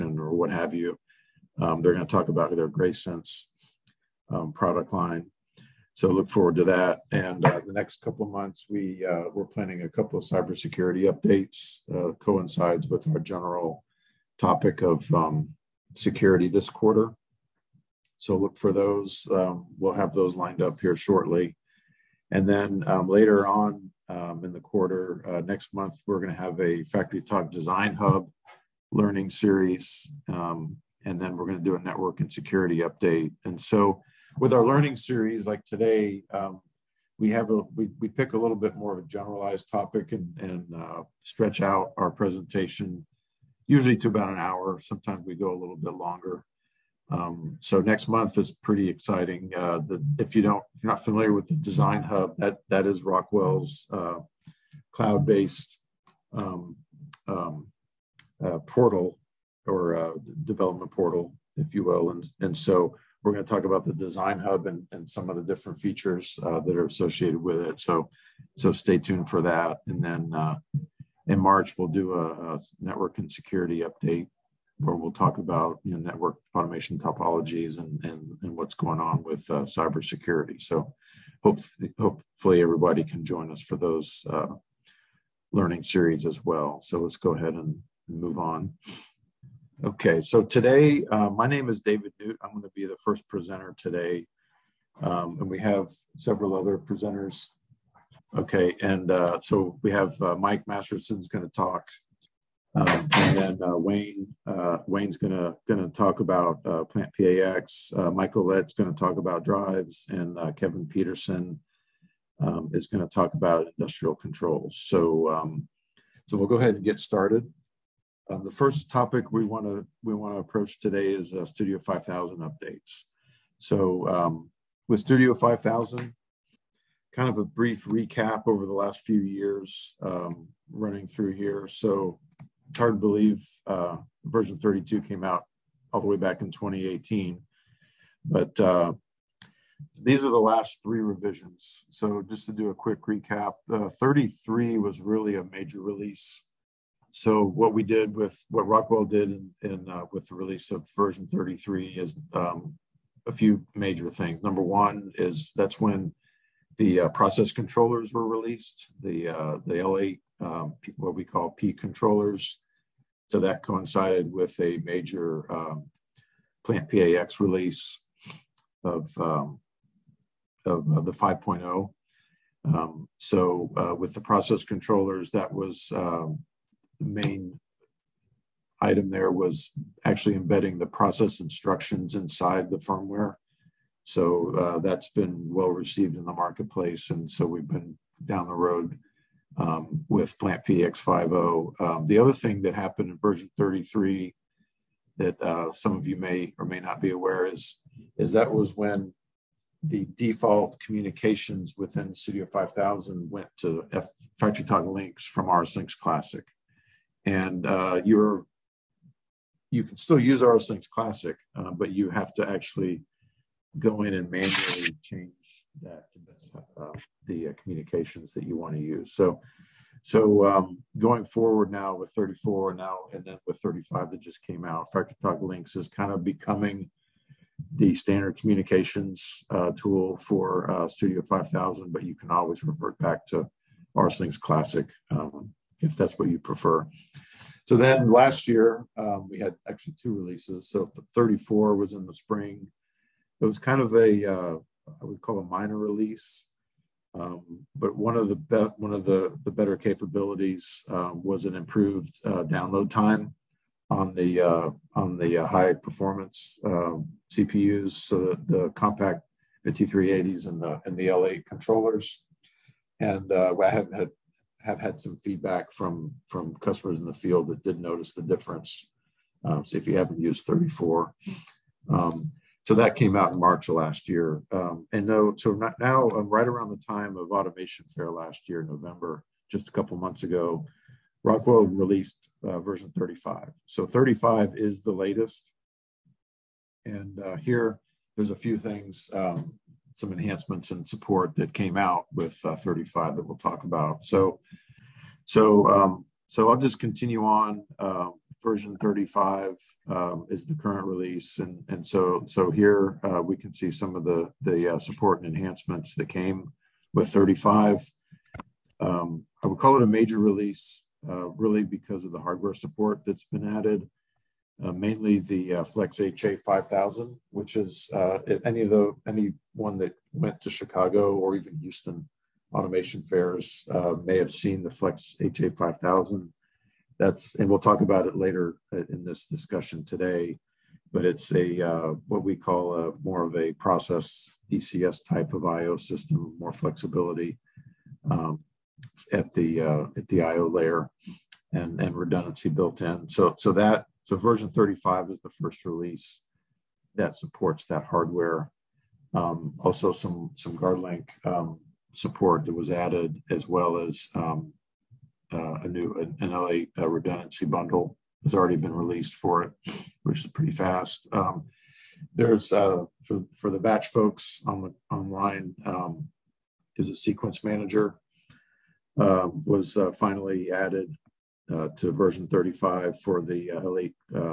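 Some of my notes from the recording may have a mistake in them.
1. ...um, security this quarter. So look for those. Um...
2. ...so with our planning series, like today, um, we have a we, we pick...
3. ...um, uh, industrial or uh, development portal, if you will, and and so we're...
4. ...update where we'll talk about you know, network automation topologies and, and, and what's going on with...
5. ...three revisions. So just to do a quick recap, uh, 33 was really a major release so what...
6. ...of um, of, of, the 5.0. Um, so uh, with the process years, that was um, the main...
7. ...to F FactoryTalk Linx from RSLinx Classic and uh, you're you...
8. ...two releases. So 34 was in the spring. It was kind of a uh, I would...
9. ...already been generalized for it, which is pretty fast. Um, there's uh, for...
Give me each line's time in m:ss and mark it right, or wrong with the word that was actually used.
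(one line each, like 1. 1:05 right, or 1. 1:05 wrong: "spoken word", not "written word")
1. 0:15 right
2. 0:33 wrong: "learning", not "planning"
3. 0:57 wrong: "portal", not "industrial"
4. 1:13 right
5. 2:20 right
6. 2:48 wrong: "controllers", not "years"
7. 3:23 right
8. 4:00 right
9. 5:58 wrong: "released", not "generalized".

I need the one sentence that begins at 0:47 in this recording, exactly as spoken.
Um, so next month is pretty exciting.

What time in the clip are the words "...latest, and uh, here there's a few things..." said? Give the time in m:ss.
4:44.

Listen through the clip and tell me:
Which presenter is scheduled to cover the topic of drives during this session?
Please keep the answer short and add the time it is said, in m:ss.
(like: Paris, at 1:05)
Michael Lett, at 1:48.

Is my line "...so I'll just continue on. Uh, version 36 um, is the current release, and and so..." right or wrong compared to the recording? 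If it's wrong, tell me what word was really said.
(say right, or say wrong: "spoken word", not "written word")
wrong: "35", not "36".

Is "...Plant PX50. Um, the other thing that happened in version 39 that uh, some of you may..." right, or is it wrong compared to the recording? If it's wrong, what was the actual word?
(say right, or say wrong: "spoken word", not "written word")
wrong: "33", not "39".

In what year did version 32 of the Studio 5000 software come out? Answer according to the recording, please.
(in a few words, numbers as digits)
2018.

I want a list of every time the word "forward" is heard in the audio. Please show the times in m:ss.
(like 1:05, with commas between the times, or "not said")
0:06, 3:41.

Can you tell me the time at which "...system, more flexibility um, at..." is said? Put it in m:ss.
5:35.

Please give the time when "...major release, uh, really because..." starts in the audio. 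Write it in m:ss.
5:09.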